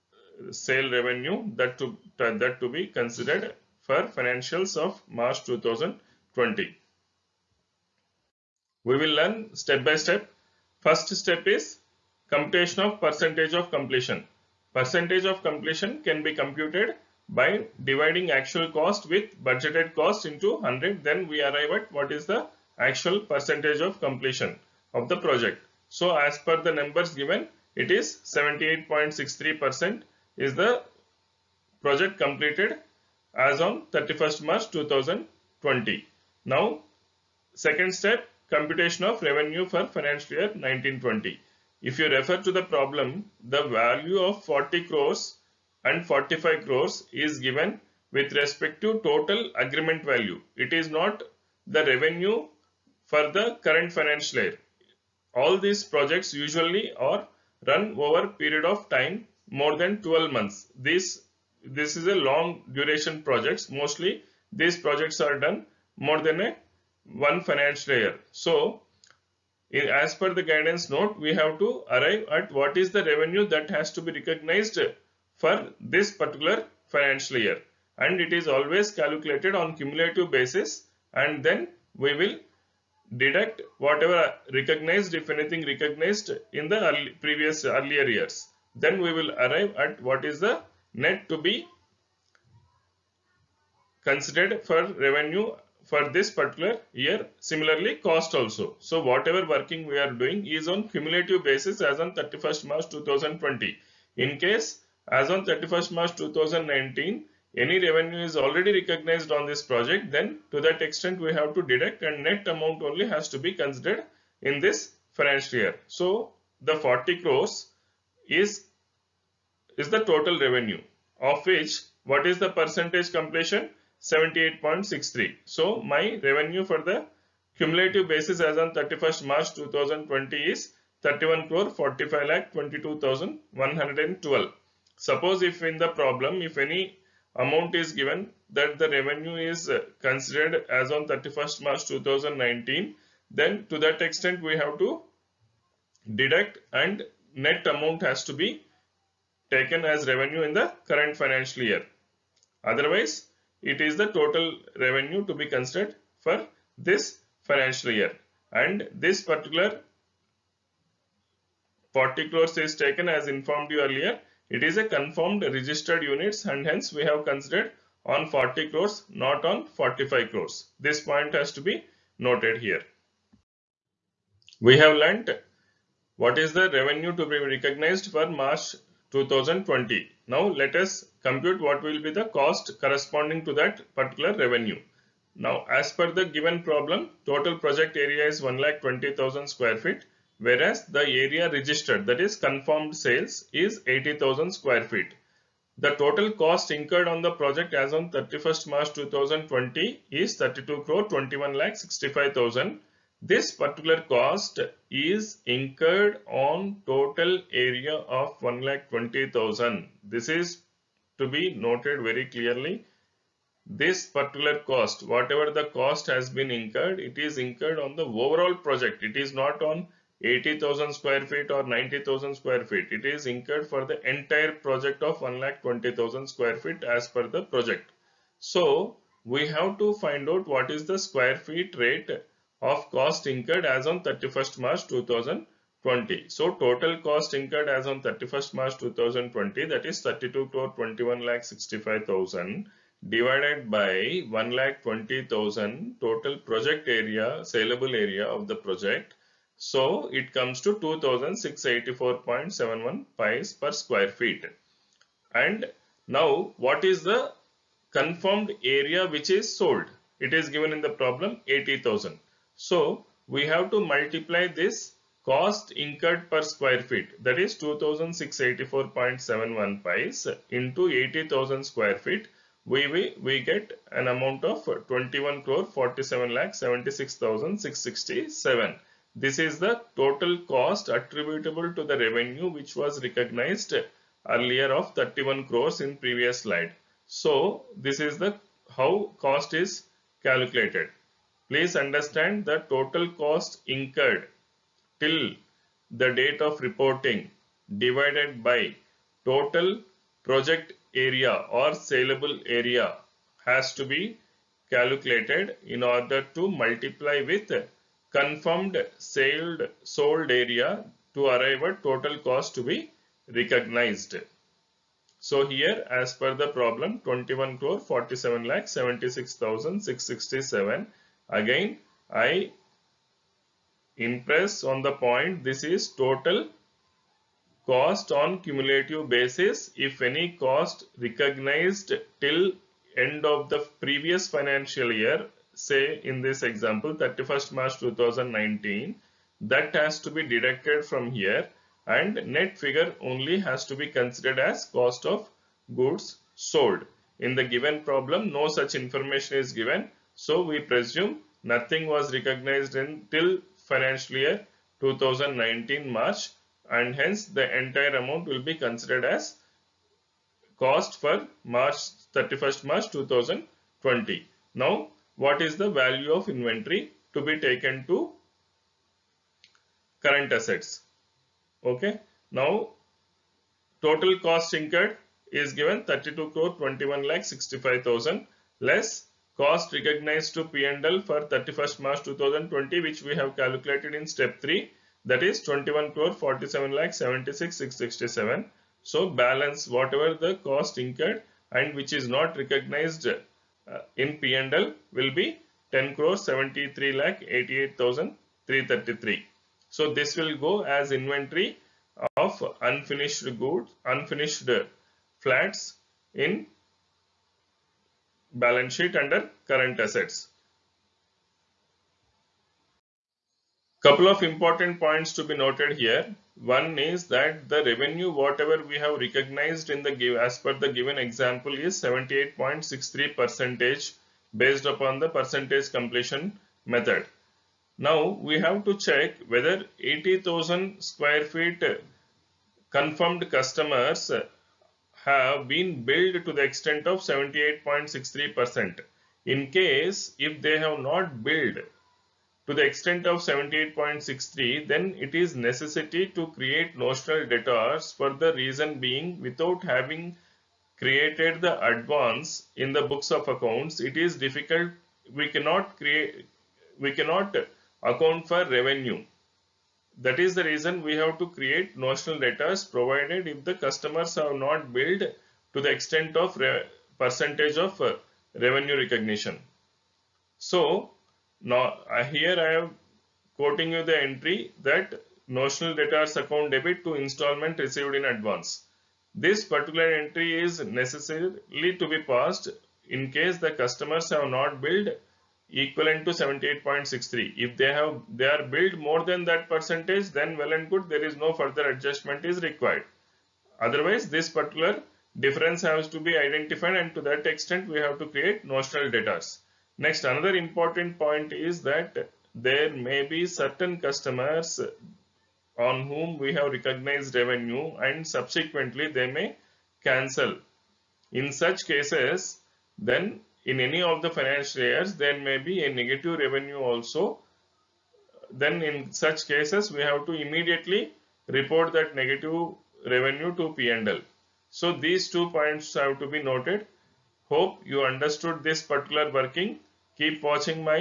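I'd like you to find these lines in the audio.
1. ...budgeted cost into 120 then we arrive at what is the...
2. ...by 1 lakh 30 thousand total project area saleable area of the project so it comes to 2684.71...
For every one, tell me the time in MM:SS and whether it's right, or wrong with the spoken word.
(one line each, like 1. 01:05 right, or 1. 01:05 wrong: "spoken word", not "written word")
1. 00:19 wrong: "100", not "120"
2. 04:03 wrong: "20", not "30".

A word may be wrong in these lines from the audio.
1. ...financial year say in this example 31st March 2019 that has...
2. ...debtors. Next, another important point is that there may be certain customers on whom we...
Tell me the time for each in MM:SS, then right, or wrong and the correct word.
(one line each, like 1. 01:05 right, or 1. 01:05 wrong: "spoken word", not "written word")
1. 05:34 right
2. 08:18 right.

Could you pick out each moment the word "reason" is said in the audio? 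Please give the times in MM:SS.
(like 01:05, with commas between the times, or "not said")
07:28, 07:40.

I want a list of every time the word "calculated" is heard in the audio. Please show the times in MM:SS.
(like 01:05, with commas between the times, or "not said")
01:18, 04:50, 05:04, 06:23.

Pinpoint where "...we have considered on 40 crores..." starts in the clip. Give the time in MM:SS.
02:46.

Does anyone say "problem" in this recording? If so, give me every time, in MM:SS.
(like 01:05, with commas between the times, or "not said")
00:42, 02:15, 03:06, 04:20, 05:16, 05:47.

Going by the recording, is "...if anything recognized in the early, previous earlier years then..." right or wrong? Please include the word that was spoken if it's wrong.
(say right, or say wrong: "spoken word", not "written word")
right.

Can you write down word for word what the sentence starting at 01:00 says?
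This, this is a long duration projects.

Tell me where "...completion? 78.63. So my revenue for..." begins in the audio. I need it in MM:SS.
02:03.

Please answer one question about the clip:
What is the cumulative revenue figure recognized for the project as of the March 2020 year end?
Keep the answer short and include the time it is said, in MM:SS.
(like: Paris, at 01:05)
31 crore 45 lakh 112, at 02:11.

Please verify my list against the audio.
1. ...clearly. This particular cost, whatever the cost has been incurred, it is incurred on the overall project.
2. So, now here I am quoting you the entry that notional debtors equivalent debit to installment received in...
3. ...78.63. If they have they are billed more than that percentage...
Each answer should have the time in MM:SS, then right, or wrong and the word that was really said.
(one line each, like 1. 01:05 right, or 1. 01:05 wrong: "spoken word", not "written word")
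1. 03:32 right
2. 07:50 wrong: "account", not "equivalent"
3. 08:06 right.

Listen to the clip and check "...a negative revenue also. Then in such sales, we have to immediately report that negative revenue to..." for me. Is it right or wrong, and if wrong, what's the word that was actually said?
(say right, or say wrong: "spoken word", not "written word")
wrong: "cases", not "sales".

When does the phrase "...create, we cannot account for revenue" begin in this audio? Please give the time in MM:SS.
07:35.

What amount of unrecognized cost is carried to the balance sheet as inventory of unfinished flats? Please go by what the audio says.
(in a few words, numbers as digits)
10 crores 73 lakh 88,333.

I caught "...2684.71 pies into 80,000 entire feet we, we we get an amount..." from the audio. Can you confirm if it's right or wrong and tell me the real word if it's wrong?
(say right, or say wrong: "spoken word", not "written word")
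wrong: "square", not "entire".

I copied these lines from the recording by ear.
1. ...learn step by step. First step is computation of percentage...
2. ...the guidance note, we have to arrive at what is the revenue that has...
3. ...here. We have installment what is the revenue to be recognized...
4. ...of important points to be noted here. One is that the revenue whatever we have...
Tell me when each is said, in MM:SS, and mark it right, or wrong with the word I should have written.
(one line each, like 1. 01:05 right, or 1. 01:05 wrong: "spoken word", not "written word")
1. 00:09 right
2. 01:10 right
3. 02:52 wrong: "learnt", not "installment"
4. 06:54 right.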